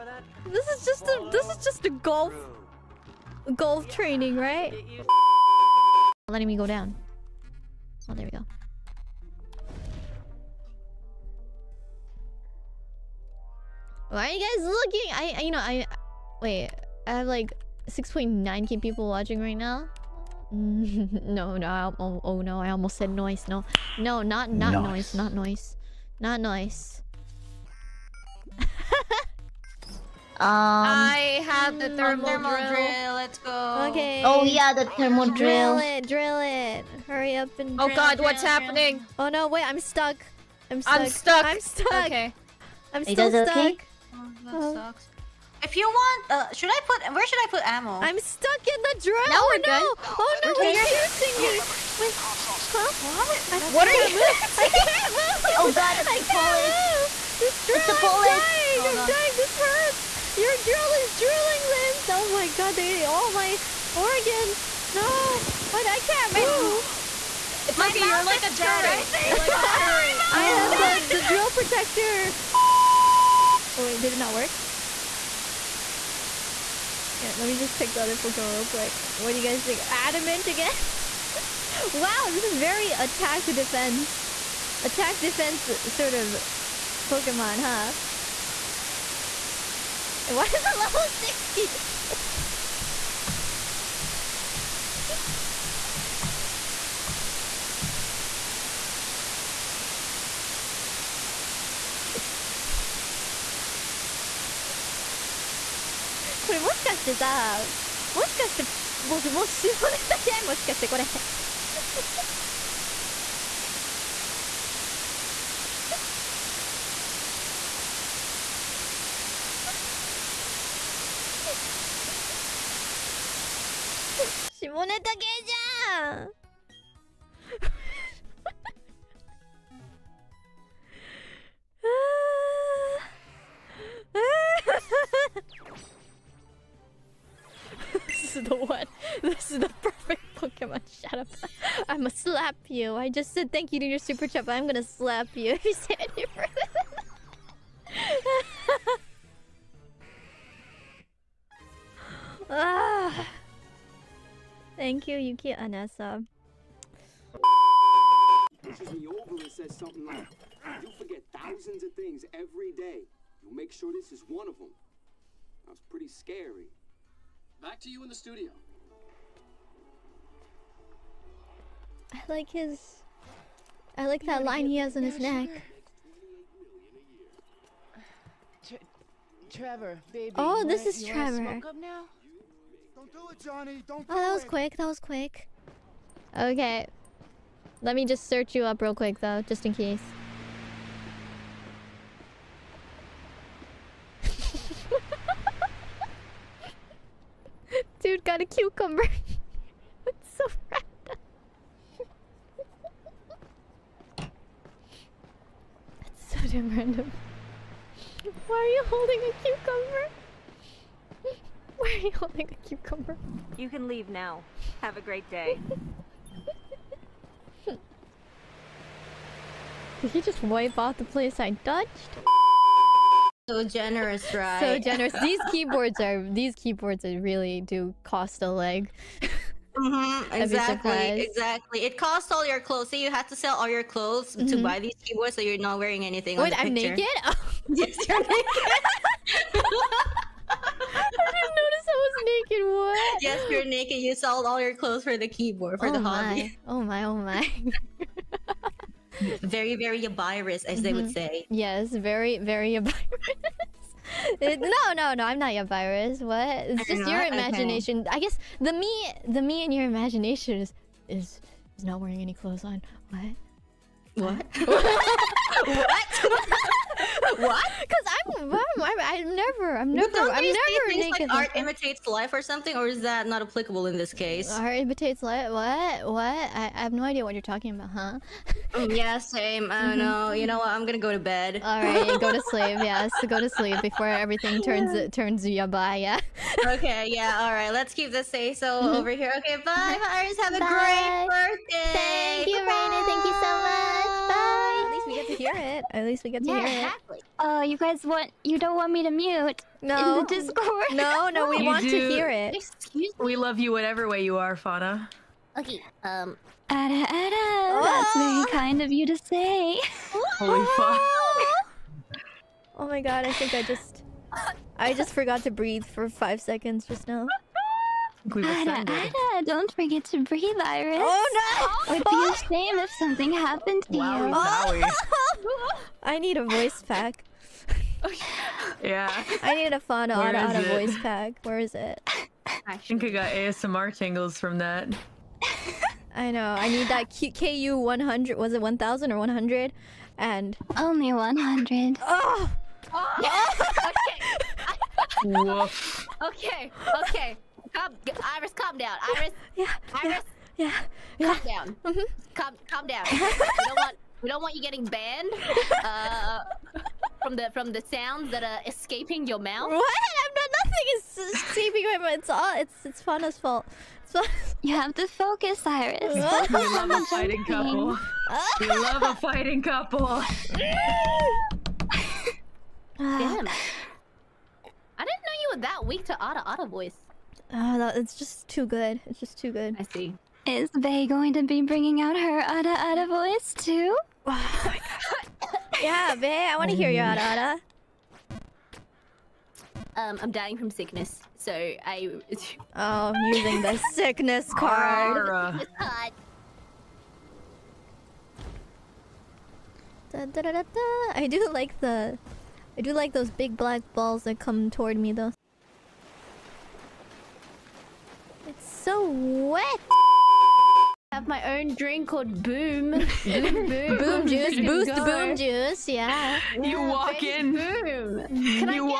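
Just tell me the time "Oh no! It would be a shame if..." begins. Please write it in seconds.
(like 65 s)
321 s.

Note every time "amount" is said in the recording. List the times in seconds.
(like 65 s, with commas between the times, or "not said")
not said.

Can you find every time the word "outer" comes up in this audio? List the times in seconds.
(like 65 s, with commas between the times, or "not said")
not said.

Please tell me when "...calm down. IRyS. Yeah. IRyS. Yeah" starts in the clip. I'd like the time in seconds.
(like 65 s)
348 s.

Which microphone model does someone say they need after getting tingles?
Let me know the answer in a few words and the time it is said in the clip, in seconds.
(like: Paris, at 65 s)
KU 100, at 337 s.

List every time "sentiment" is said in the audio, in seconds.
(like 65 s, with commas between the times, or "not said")
not said.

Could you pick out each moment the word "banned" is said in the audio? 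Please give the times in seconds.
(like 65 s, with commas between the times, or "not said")
354 s.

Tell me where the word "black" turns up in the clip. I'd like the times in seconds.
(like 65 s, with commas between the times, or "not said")
403 s.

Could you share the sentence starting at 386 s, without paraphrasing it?
I want to hear your yada Um, I'm dying from sickness, so I.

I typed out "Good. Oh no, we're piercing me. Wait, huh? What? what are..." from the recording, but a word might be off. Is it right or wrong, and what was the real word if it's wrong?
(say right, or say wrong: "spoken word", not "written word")
right.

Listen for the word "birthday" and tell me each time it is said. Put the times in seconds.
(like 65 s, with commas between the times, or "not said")
291 s.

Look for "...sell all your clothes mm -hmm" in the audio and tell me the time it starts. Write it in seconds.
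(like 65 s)
233 s.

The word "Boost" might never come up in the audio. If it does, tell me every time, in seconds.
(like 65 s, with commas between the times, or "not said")
414 s.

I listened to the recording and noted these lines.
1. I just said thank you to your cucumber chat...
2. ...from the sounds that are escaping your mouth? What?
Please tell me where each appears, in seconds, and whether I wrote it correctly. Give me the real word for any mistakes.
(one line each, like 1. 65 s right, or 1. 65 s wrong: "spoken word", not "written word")
1. 142 s wrong: "super", not "cucumber"
2. 357 s right.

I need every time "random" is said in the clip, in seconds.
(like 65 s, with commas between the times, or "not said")
200 s, 206 s.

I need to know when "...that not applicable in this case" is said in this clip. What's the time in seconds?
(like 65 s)
273 s.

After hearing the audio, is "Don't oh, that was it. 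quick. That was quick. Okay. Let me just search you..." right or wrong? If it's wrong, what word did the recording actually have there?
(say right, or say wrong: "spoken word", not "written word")
right.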